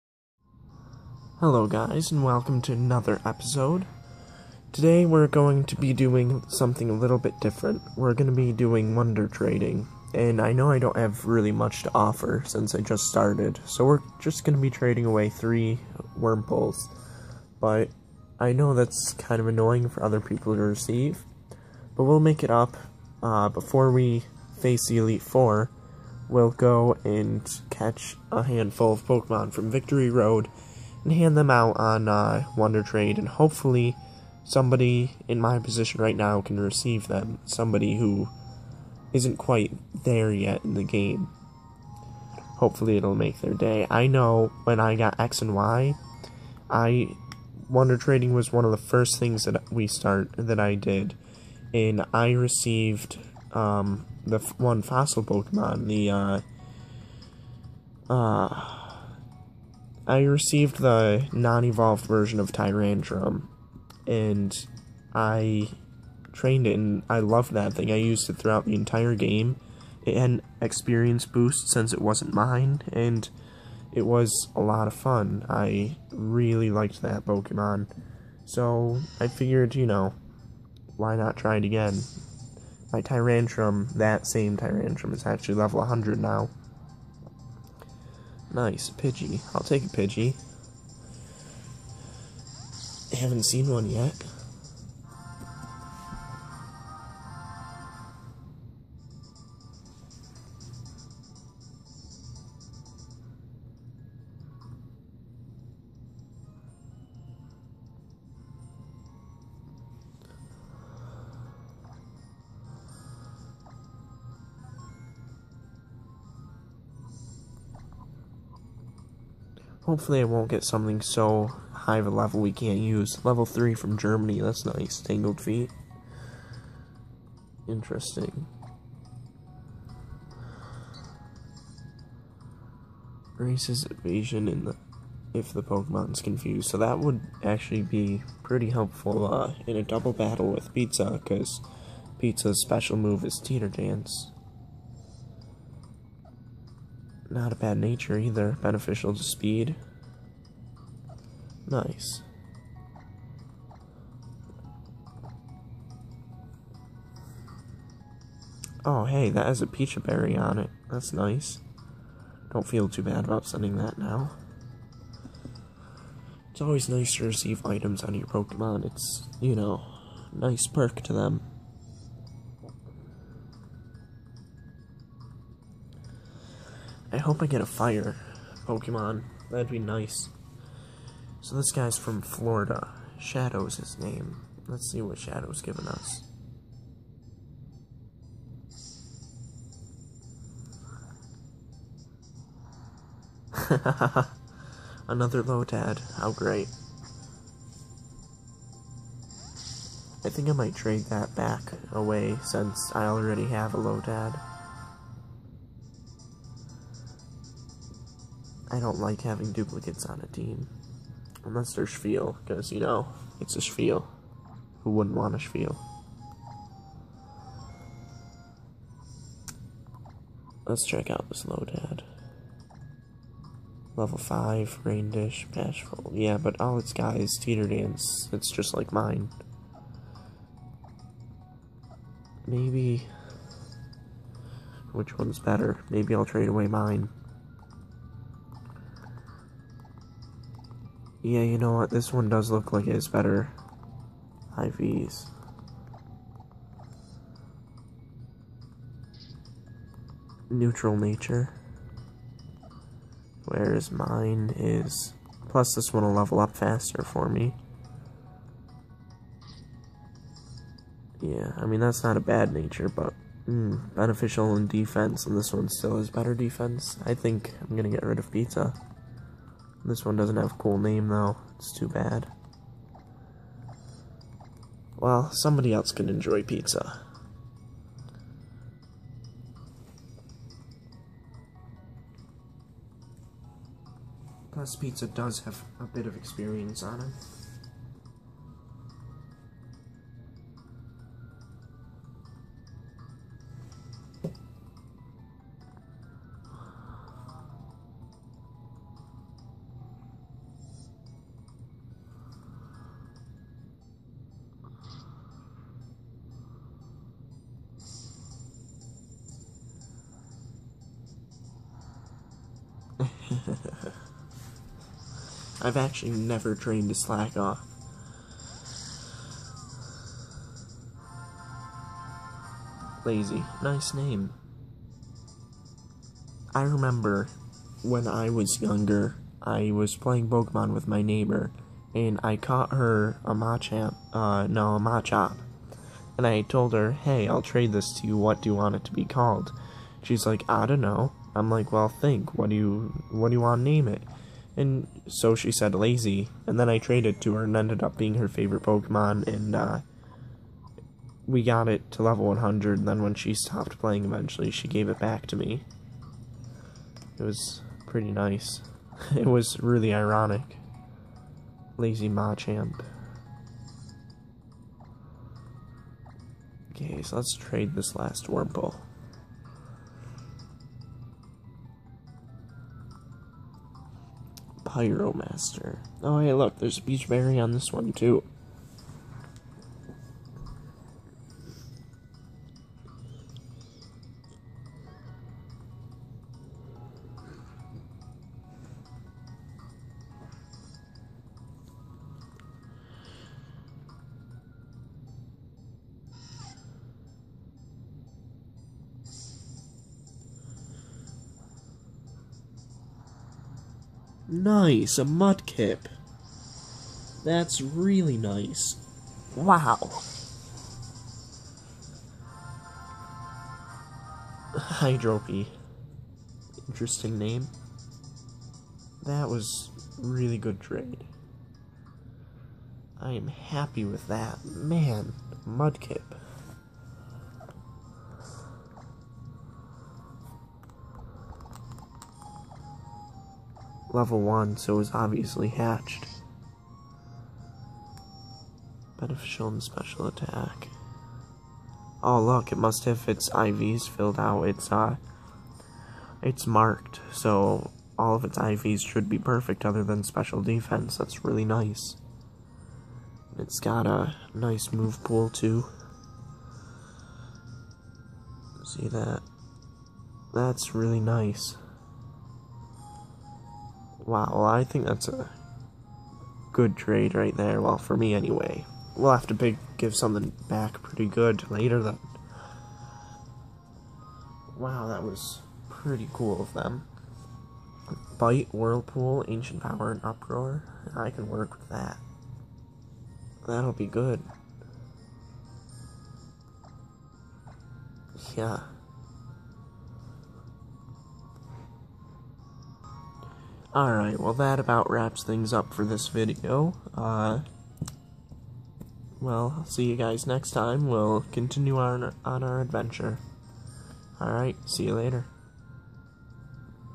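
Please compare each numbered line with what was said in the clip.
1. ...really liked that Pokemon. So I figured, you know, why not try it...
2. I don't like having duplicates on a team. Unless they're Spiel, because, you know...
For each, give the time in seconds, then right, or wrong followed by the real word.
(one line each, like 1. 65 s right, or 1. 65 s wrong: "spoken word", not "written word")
1. 76 s right
2. 208 s right.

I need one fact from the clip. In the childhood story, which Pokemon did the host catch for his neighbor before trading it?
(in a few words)
Machop.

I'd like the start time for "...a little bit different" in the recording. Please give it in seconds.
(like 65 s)
6 s.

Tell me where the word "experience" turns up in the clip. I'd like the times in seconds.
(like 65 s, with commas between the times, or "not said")
70 s, 286 s.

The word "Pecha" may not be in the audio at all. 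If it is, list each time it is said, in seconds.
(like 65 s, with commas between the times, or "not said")
159 s, 376 s.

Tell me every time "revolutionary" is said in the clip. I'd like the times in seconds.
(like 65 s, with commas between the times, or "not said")
not said.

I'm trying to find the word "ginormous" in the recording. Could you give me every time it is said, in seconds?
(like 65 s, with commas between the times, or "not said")
not said.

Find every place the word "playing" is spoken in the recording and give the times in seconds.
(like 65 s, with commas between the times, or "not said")
329 s, 353 s.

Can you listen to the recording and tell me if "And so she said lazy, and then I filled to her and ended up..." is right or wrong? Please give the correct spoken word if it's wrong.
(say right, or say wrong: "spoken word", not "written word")
wrong: "traded", not "filled".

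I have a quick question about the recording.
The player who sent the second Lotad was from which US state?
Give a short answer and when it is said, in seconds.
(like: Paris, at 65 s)
Florida, at 182 s.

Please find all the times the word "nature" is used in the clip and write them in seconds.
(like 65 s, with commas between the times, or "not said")
147 s, 250 s, 262 s.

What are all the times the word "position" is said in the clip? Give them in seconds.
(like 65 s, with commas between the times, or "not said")
35 s.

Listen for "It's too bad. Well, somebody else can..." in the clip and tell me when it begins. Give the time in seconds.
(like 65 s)
271 s.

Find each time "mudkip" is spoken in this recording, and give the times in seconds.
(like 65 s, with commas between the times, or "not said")
405 s, 425 s.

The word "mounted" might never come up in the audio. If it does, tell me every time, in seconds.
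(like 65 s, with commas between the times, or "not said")
not said.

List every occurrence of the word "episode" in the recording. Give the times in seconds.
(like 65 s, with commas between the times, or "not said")
3 s.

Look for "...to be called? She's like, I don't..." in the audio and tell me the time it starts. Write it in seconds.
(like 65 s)
338 s.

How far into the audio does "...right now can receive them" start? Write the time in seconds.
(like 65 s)
36 s.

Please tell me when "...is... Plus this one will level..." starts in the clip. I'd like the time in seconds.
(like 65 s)
254 s.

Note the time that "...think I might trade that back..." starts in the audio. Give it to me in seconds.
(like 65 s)
200 s.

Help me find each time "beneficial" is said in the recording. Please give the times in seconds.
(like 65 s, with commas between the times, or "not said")
148 s, 263 s, 438 s.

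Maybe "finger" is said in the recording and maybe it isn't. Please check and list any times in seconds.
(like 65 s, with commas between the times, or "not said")
not said.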